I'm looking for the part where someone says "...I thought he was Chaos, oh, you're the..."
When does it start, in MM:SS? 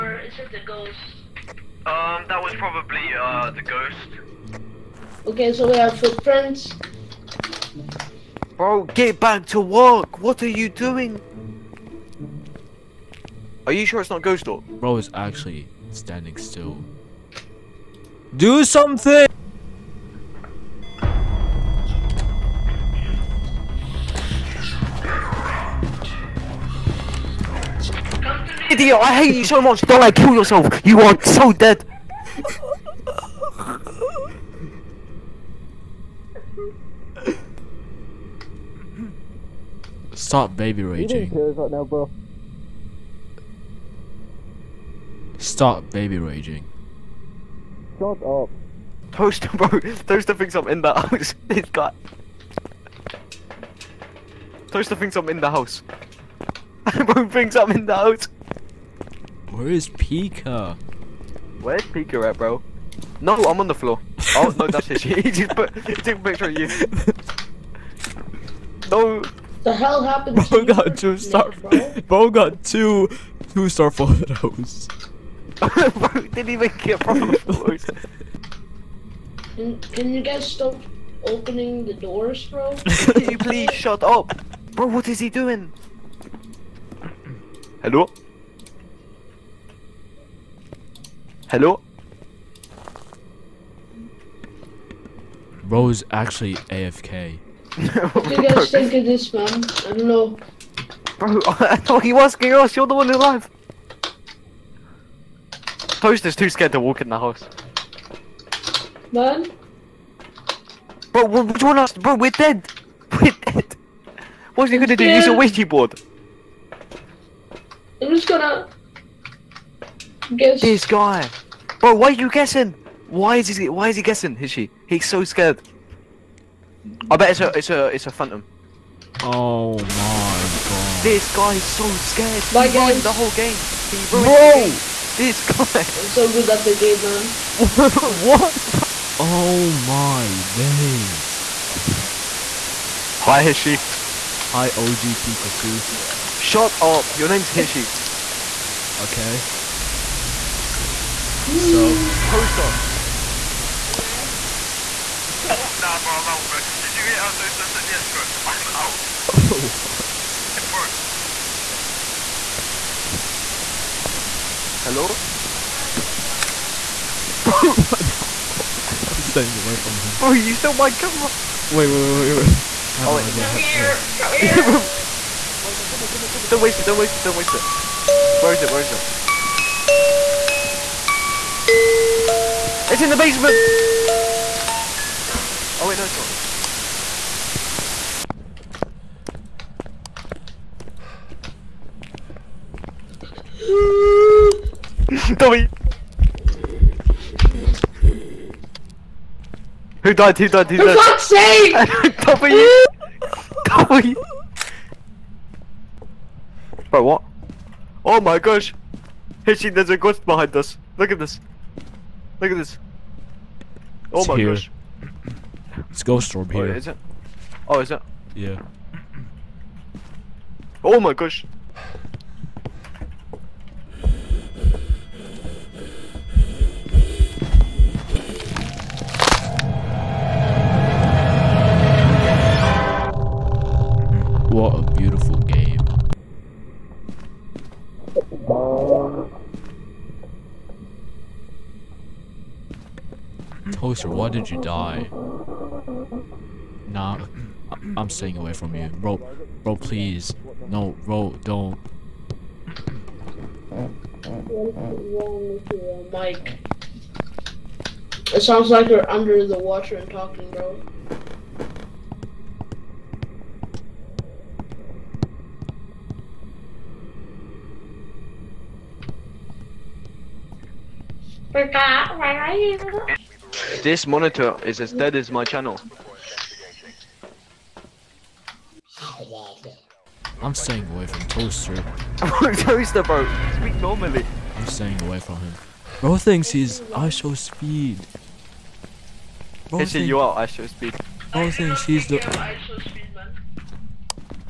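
01:41.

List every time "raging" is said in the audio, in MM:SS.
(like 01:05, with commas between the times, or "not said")
00:40, 00:46.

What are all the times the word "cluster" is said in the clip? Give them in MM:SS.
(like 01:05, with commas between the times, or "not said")
not said.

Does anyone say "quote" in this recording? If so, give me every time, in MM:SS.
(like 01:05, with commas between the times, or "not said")
not said.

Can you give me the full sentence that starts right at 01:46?
Post is too scared to walk in the house.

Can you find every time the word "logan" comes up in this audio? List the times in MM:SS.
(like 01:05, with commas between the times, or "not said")
not said.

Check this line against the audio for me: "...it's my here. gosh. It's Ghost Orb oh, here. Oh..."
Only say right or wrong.
right.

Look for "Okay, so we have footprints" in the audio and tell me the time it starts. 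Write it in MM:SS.
00:05.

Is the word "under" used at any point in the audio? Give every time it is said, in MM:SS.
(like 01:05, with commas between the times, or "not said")
04:19.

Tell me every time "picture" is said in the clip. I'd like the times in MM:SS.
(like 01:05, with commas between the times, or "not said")
01:06.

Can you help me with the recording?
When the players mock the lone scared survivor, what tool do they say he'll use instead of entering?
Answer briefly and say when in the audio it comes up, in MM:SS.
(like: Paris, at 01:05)
Ouija board, at 01:55.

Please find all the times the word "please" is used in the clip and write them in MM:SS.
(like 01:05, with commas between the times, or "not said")
01:23, 04:09.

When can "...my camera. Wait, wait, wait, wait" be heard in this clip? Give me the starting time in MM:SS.
02:50.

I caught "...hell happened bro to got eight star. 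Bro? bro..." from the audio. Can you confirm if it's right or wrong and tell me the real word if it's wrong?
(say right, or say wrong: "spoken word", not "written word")
wrong: "two", not "eight".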